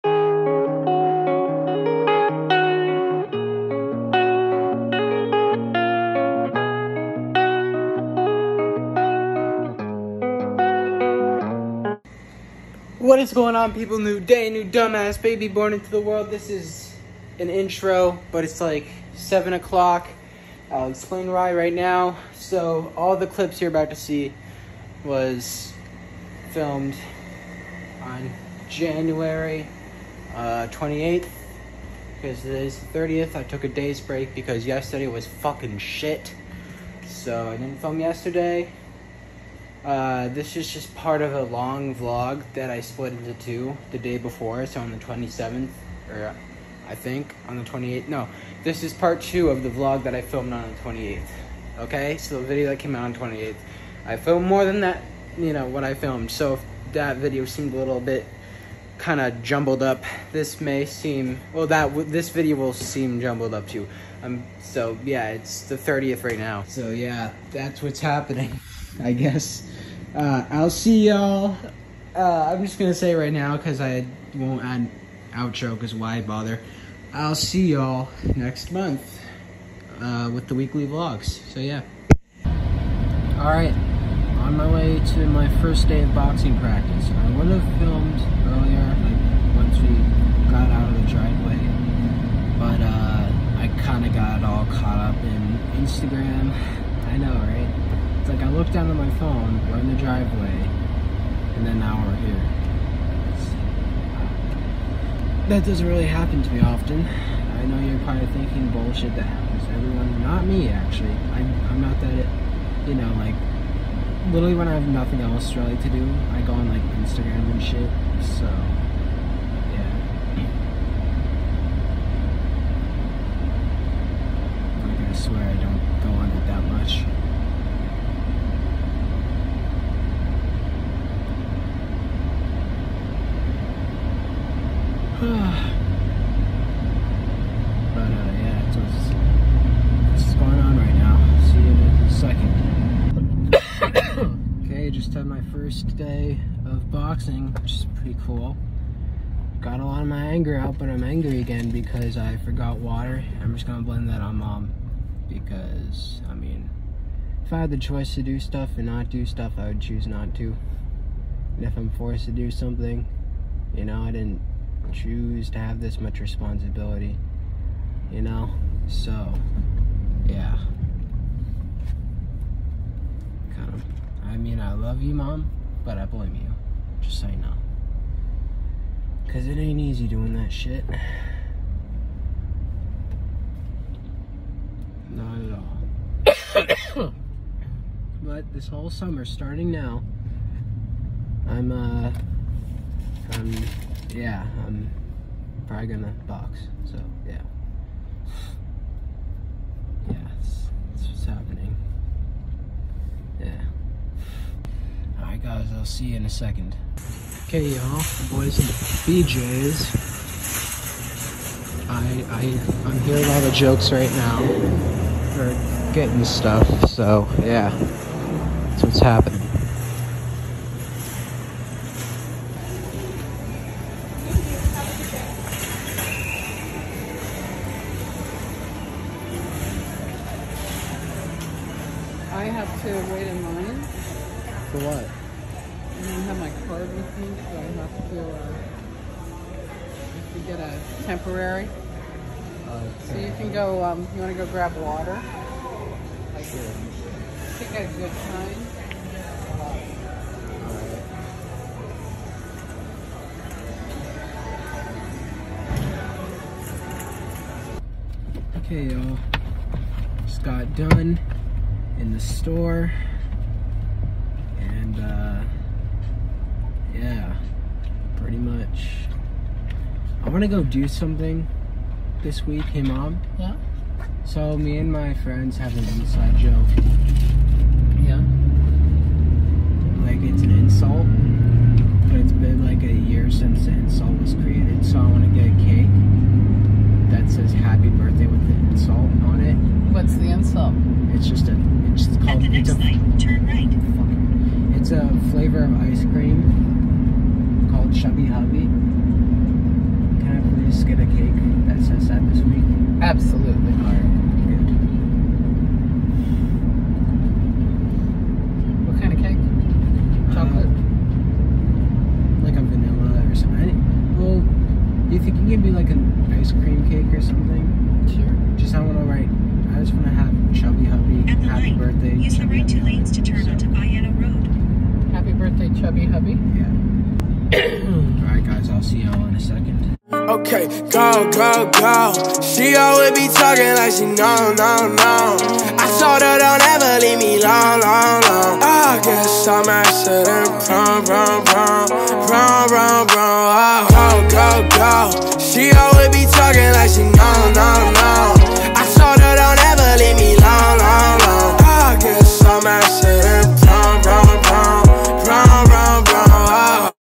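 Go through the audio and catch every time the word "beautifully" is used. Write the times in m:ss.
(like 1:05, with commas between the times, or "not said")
not said.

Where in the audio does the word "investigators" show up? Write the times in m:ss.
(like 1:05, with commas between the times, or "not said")
not said.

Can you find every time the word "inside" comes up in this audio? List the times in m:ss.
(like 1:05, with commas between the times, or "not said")
4:36.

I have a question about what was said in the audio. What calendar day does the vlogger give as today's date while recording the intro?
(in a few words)
30th.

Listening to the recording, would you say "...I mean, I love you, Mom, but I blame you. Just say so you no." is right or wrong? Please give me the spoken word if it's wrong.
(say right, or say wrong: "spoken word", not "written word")
right.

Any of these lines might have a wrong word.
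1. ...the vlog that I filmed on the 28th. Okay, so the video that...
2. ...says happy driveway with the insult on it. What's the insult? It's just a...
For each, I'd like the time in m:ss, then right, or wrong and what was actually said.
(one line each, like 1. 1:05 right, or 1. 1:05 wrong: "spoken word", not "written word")
1. 0:49 right
2. 4:47 wrong: "birthday", not "driveway".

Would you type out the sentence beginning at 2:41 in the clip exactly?
And if I'm forced to do something, you know, I didn't choose to have this much responsibility, you know?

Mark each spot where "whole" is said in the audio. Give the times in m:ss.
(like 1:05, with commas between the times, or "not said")
3:08.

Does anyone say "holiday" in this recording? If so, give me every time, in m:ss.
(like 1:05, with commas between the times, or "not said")
not said.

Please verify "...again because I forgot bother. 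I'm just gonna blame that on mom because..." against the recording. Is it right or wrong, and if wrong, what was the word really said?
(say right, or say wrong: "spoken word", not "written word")
wrong: "water", not "bother".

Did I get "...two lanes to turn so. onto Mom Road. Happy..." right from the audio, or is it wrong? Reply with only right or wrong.
wrong.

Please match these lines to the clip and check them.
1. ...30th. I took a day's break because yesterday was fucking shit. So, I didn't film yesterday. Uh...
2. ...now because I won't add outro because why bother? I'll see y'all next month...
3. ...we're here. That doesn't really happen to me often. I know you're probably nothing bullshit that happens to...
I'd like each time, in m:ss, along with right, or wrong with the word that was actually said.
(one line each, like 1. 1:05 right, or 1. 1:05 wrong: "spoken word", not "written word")
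1. 0:32 right
2. 1:13 right
3. 1:42 wrong: "thinking", not "nothing".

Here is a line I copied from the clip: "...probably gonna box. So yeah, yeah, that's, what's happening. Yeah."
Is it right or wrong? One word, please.
right.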